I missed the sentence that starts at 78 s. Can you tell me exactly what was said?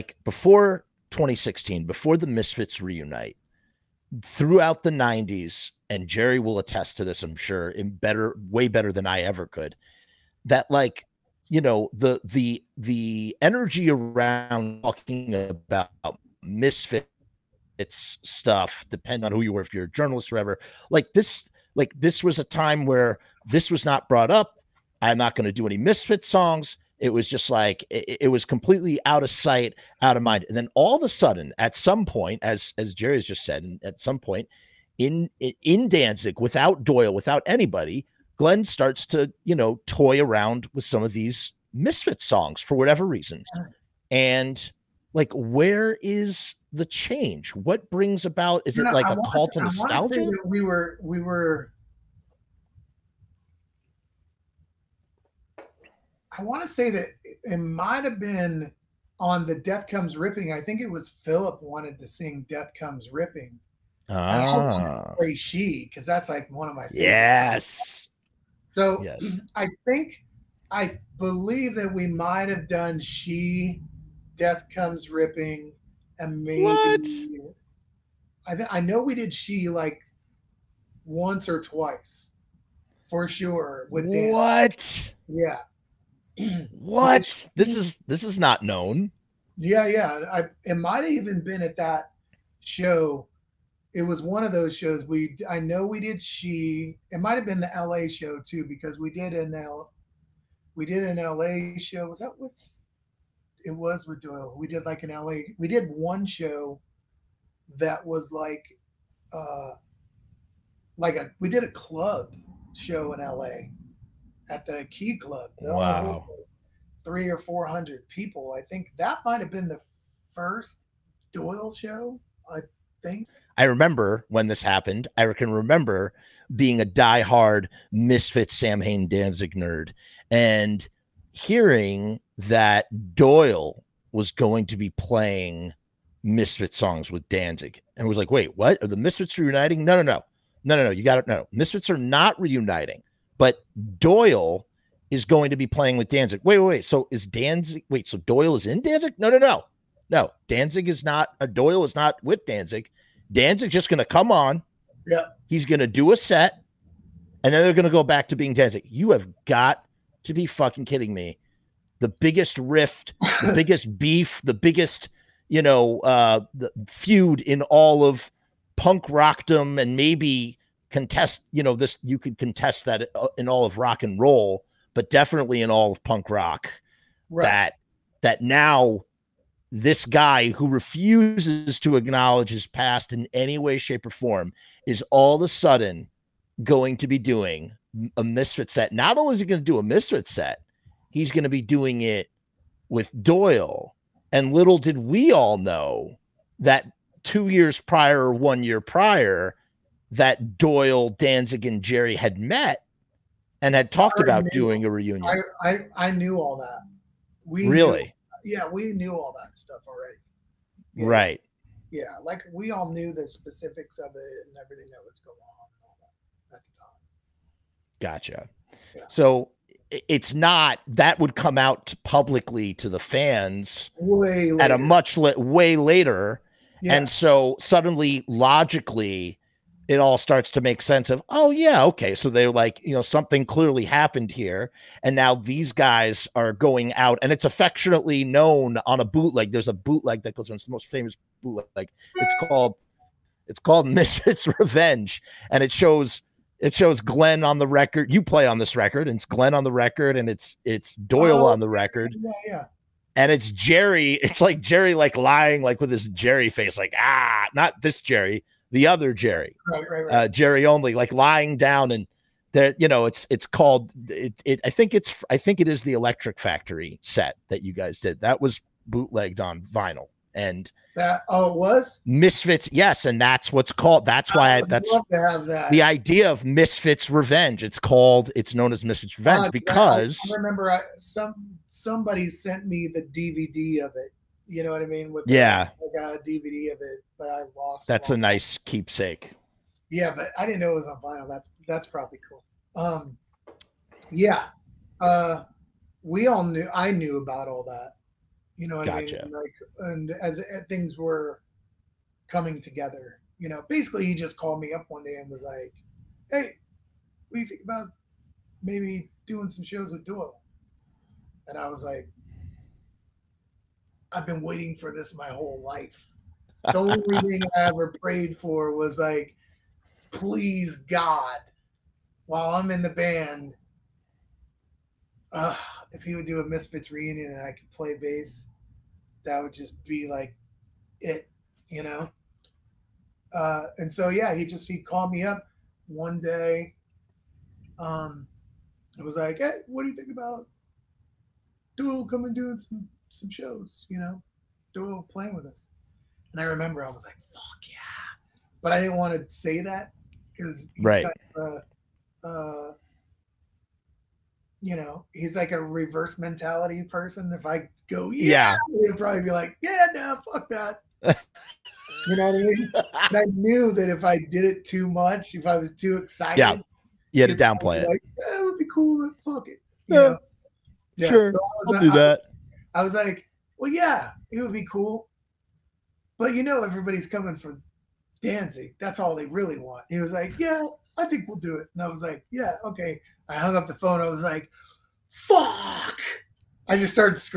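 I th- I know we did she like once or twice for sure.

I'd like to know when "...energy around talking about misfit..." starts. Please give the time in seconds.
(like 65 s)
13 s.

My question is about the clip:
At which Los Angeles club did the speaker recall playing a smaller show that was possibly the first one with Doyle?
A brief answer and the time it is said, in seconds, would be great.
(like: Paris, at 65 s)
Key Club, at 114 s.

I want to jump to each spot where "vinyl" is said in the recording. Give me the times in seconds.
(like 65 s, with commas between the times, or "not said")
269 s, 291 s.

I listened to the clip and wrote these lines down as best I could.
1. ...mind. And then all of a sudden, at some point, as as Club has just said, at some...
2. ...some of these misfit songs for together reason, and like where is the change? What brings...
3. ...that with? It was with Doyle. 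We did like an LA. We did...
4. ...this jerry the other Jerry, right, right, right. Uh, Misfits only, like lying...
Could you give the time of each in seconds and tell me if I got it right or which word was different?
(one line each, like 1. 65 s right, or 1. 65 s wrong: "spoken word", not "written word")
1. 30 s wrong: "Jerry", not "Club"
2. 40 s wrong: "whatever", not "together"
3. 102 s right
4. 257 s wrong: "Jerry", not "Misfits".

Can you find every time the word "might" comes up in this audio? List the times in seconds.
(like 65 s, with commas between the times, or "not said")
57 s, 72 s, 90 s, 97 s, 119 s.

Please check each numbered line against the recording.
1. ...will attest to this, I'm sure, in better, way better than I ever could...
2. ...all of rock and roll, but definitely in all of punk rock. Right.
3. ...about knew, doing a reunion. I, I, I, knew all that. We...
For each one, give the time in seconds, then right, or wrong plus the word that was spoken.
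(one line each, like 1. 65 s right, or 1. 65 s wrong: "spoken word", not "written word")
1. 6 s right
2. 173 s right
3. 204 s right.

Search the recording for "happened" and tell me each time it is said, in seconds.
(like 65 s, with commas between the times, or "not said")
124 s, 233 s.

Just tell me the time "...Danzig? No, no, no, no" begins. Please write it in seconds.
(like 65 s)
148 s.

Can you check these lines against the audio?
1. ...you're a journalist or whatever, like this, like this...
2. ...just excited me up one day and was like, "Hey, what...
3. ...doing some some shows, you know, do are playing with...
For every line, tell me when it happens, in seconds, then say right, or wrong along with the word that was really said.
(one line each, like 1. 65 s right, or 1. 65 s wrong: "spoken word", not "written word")
1. 19 s right
2. 304 s wrong: "called", not "excited"
3. 342 s right.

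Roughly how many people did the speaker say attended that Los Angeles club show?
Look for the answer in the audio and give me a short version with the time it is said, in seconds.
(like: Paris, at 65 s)
300 or 400, at 117 s.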